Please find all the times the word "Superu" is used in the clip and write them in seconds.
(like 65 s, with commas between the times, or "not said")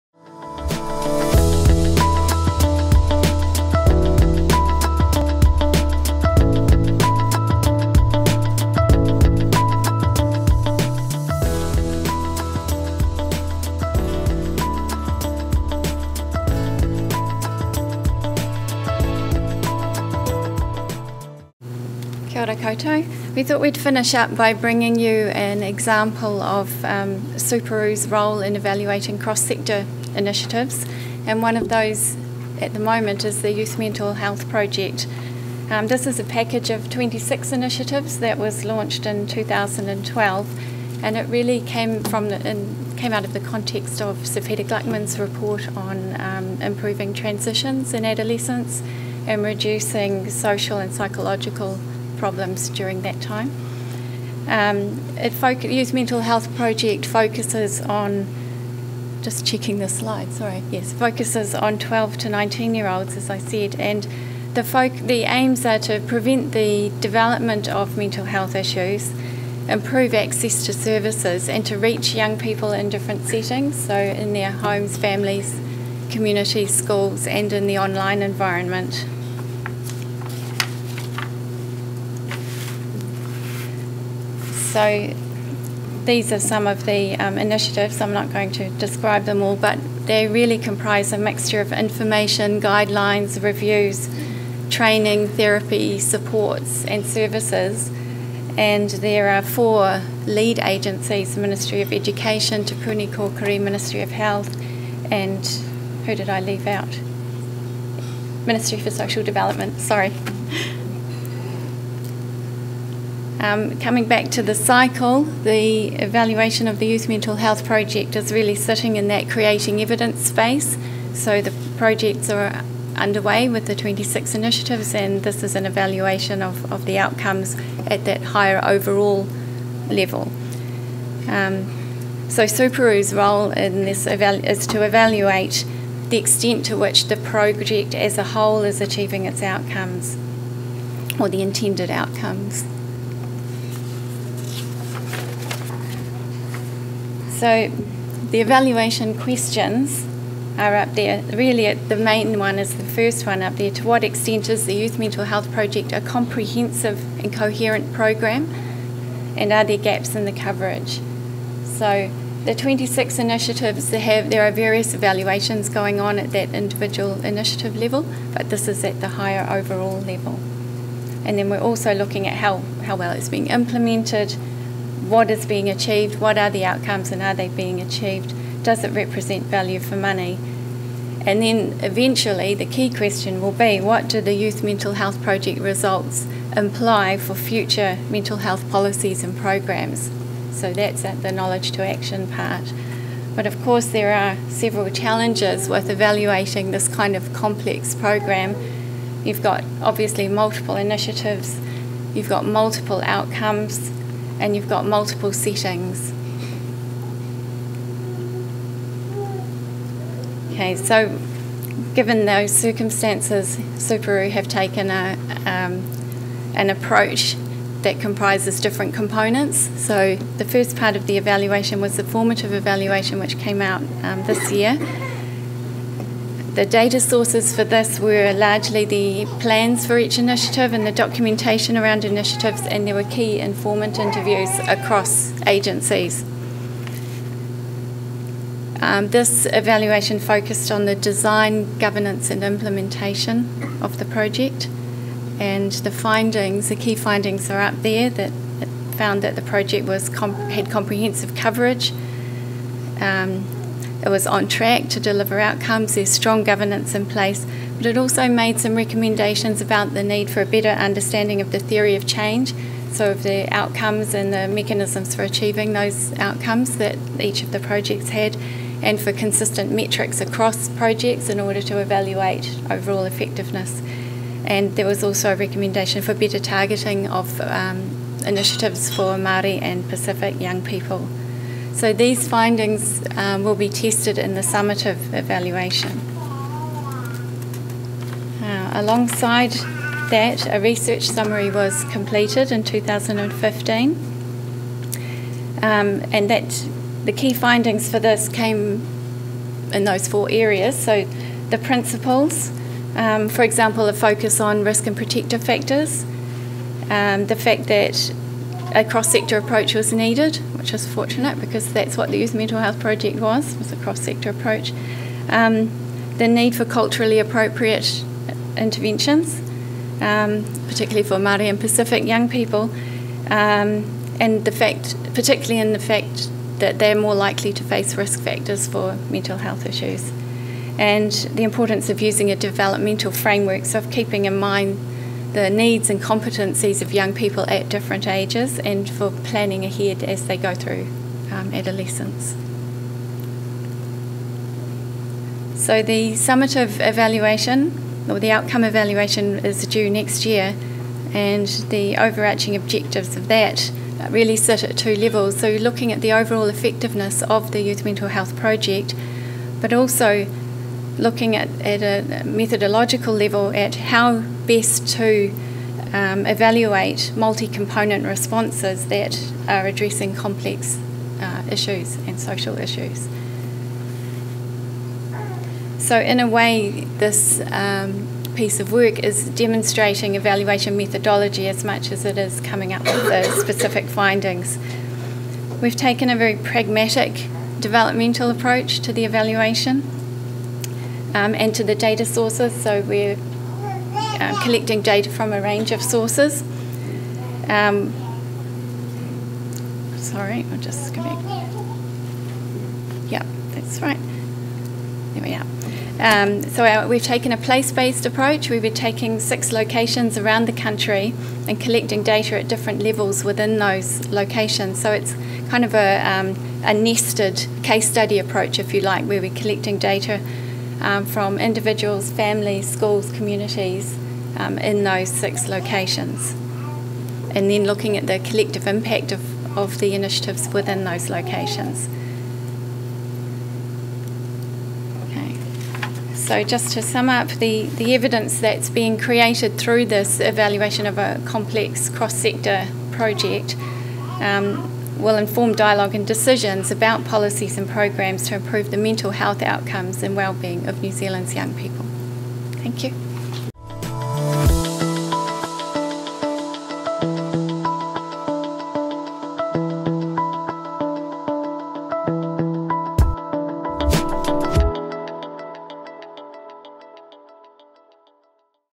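132 s, 213 s.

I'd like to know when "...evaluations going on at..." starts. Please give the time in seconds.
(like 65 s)
164 s.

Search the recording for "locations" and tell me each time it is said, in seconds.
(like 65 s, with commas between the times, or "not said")
409 s, 414 s, 425 s, 431 s.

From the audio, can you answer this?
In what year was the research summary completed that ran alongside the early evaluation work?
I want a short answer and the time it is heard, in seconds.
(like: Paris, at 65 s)
2015, at 292 s.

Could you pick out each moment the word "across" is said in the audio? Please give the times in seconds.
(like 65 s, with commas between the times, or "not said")
234 s, 270 s.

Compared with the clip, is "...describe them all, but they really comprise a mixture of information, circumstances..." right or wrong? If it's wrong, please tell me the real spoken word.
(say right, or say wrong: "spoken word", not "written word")
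wrong: "guidelines", not "circumstances".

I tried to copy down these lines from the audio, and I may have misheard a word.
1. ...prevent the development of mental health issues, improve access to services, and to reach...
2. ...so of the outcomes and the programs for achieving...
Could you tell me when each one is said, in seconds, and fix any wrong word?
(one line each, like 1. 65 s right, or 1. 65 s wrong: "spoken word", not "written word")
1. 66 s right
2. 262 s wrong: "mechanisms", not "programs".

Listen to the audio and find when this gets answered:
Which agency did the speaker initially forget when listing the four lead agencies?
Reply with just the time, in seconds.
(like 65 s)
108 s.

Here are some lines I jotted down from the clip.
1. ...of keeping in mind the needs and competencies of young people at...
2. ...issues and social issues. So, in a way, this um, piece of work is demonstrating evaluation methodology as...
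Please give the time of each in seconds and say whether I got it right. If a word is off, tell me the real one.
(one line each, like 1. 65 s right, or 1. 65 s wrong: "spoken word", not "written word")
1. 333 s right
2. 371 s right.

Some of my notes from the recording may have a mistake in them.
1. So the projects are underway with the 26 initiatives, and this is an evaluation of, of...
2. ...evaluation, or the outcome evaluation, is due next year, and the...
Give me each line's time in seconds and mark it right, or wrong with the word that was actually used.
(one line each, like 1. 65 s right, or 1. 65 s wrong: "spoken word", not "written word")
1. 121 s right
2. 346 s right.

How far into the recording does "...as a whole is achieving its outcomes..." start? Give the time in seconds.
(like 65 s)
137 s.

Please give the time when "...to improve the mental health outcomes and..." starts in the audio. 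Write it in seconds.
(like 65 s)
448 s.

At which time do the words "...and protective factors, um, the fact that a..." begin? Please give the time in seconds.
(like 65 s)
304 s.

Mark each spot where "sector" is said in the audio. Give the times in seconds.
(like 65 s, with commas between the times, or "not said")
29 s, 308 s, 313 s, 441 s.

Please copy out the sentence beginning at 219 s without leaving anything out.
So the first part of the evaluation was the formative evaluation, which came out um, this year.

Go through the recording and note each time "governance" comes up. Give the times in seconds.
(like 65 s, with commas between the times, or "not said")
241 s, 256 s.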